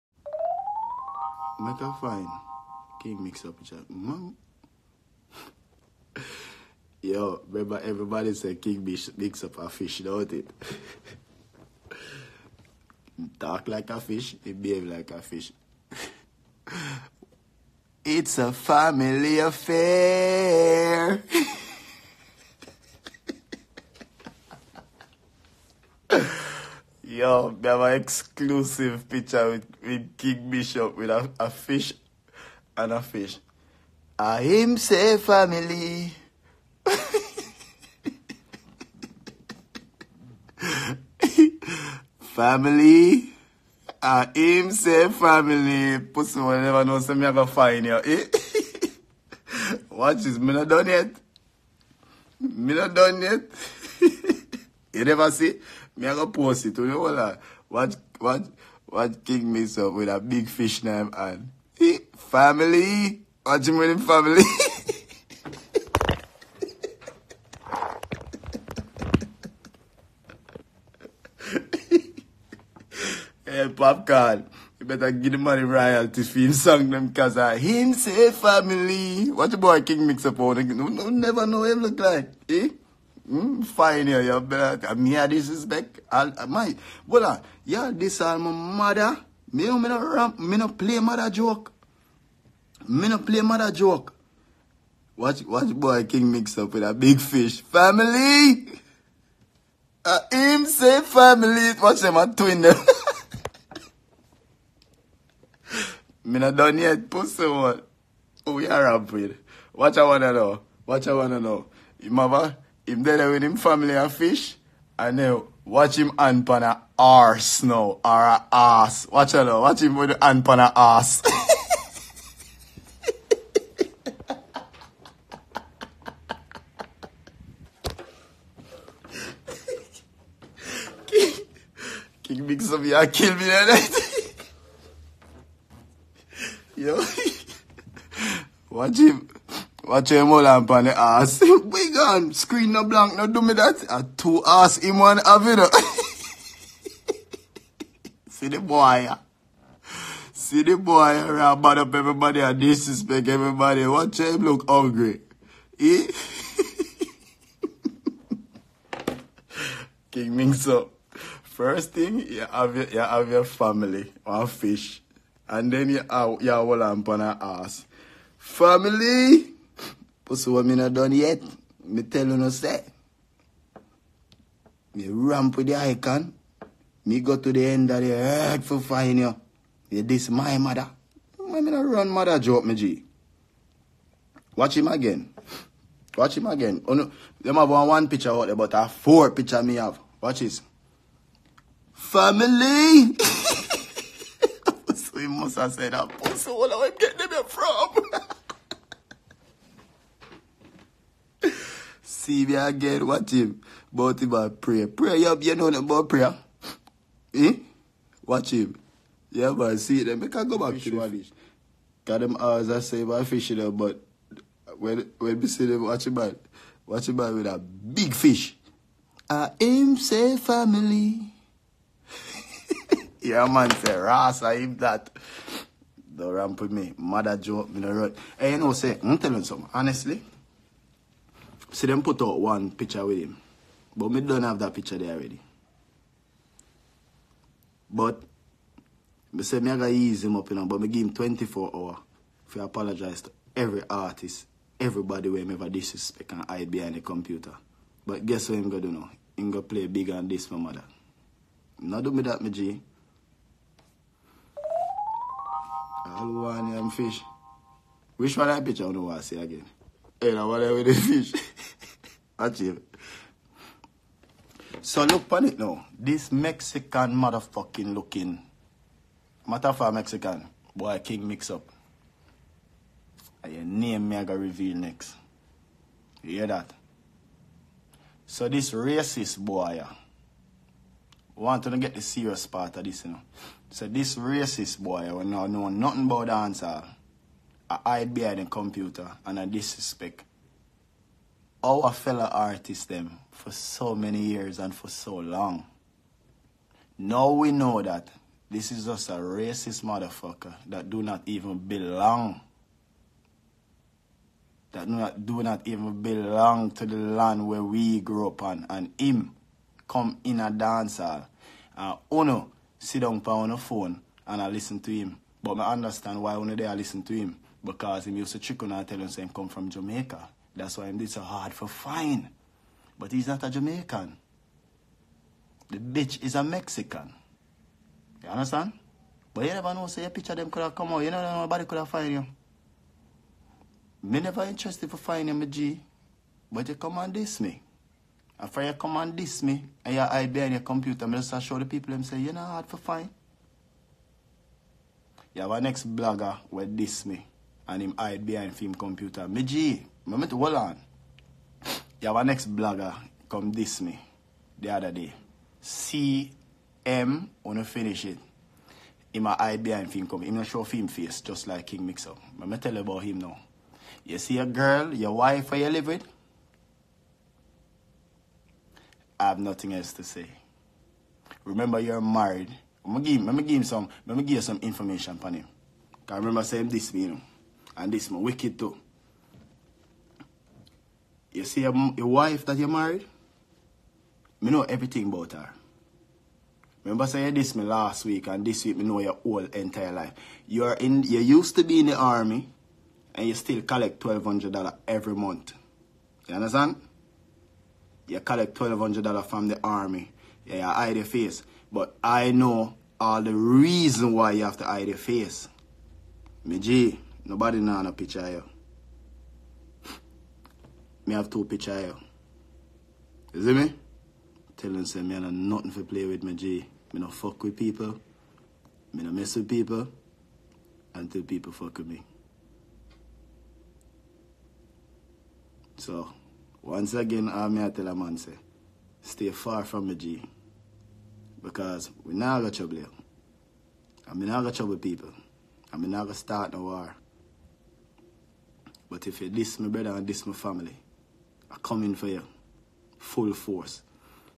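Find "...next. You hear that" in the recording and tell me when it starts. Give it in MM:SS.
04:34.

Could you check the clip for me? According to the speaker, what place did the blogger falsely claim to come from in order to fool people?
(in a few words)
Jamaica.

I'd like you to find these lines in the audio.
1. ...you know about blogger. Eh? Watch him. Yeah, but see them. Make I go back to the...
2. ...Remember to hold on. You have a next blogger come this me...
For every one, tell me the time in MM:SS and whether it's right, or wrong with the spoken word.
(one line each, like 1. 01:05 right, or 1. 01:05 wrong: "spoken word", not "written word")
1. 03:25 wrong: "prayer", not "blogger"
2. 05:50 right.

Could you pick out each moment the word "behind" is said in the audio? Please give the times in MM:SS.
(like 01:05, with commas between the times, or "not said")
04:06, 04:48, 05:40, 05:48, 05:59.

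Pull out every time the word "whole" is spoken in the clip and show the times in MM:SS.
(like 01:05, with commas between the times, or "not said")
02:46, 06:29.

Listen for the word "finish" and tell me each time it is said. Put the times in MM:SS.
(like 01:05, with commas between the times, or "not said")
05:57.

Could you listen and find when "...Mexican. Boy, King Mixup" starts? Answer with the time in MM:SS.
04:29.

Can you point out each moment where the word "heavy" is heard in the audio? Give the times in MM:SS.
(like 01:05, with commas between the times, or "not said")
not said.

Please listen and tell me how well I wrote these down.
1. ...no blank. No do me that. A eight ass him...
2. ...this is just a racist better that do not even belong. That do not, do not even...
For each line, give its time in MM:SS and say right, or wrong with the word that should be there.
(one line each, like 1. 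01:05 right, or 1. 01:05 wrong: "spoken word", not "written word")
1. 02:22 wrong: "two", not "eight"
2. 04:58 wrong: "motherfucker", not "better".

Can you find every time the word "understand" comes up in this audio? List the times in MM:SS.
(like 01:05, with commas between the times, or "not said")
05:15, 05:28, 06:36.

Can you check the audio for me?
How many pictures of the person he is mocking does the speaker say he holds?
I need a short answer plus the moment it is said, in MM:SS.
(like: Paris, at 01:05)
4, at 03:08.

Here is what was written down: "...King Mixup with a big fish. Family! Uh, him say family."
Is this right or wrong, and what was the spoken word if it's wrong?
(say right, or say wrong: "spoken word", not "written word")
right.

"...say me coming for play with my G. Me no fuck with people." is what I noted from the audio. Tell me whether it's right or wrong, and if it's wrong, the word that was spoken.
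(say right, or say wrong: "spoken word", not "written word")
wrong: "nothing", not "coming".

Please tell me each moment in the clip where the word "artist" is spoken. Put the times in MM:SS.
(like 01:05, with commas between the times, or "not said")
04:03, 04:52.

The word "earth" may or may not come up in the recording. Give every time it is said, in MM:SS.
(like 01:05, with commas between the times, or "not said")
02:58.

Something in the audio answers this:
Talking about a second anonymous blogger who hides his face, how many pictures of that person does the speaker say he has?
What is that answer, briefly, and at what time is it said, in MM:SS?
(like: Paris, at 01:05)
2, at 06:51.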